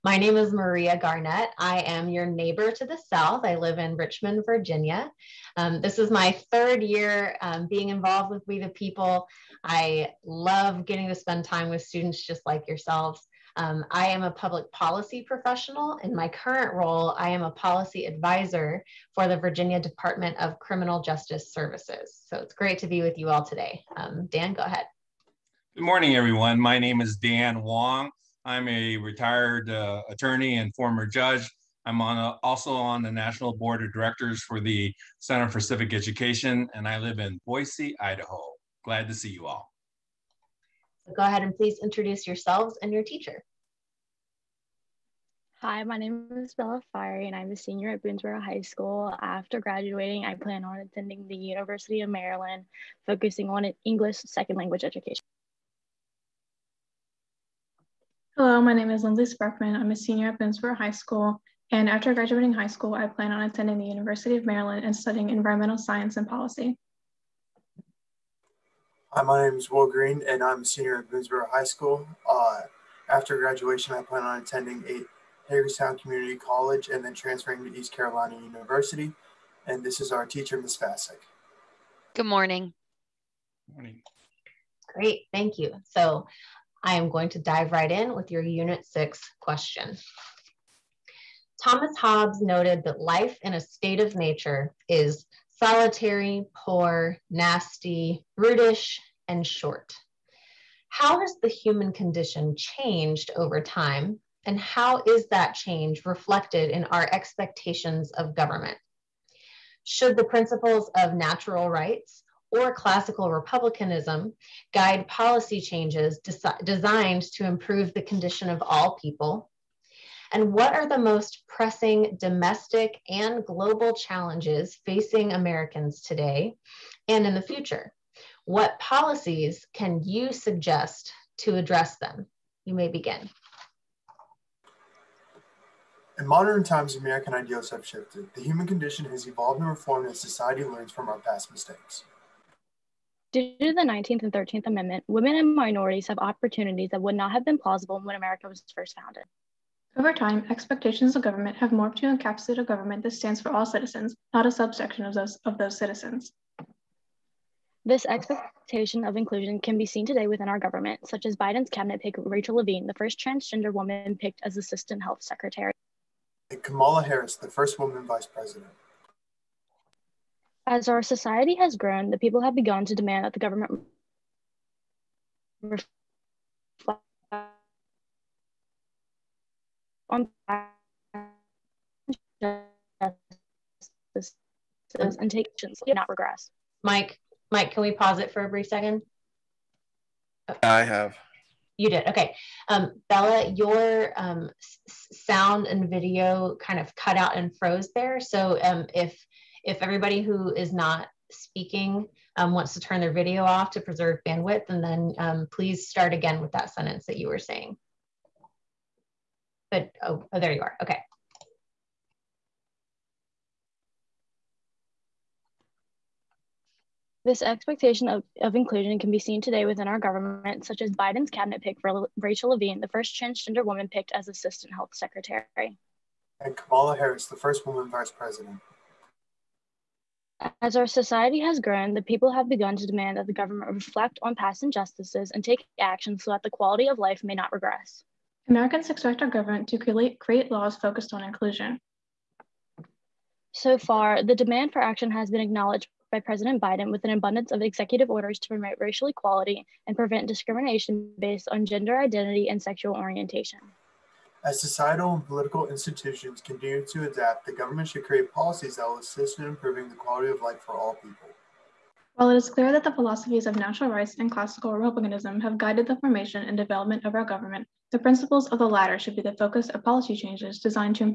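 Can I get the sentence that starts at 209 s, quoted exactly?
But, oh, oh there you are, okay.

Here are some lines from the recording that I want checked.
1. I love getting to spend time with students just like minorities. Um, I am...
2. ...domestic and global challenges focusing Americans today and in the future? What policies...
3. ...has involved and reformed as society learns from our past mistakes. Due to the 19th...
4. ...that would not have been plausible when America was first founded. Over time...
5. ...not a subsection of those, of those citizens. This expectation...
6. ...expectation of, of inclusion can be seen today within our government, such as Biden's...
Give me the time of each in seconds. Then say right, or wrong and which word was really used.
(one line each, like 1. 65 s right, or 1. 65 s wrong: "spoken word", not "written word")
1. 9 s wrong: "yourselves", not "minorities"
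2. 122 s wrong: "facing", not "focusing"
3. 139 s wrong: "evolved", not "involved"
4. 146 s right
5. 154 s right
6. 217 s right.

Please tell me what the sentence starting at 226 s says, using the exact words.
And Kamala Harris, the first woman vice president.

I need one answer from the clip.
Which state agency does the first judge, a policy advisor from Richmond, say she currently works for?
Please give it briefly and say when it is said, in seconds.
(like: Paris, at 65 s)
Virginia Department of Criminal Justice Services, at 19 s.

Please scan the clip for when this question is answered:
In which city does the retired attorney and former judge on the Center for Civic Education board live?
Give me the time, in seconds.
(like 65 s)
37 s.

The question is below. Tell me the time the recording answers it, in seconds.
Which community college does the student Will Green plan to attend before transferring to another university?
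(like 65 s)
75 s.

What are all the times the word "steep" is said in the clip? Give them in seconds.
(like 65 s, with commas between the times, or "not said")
not said.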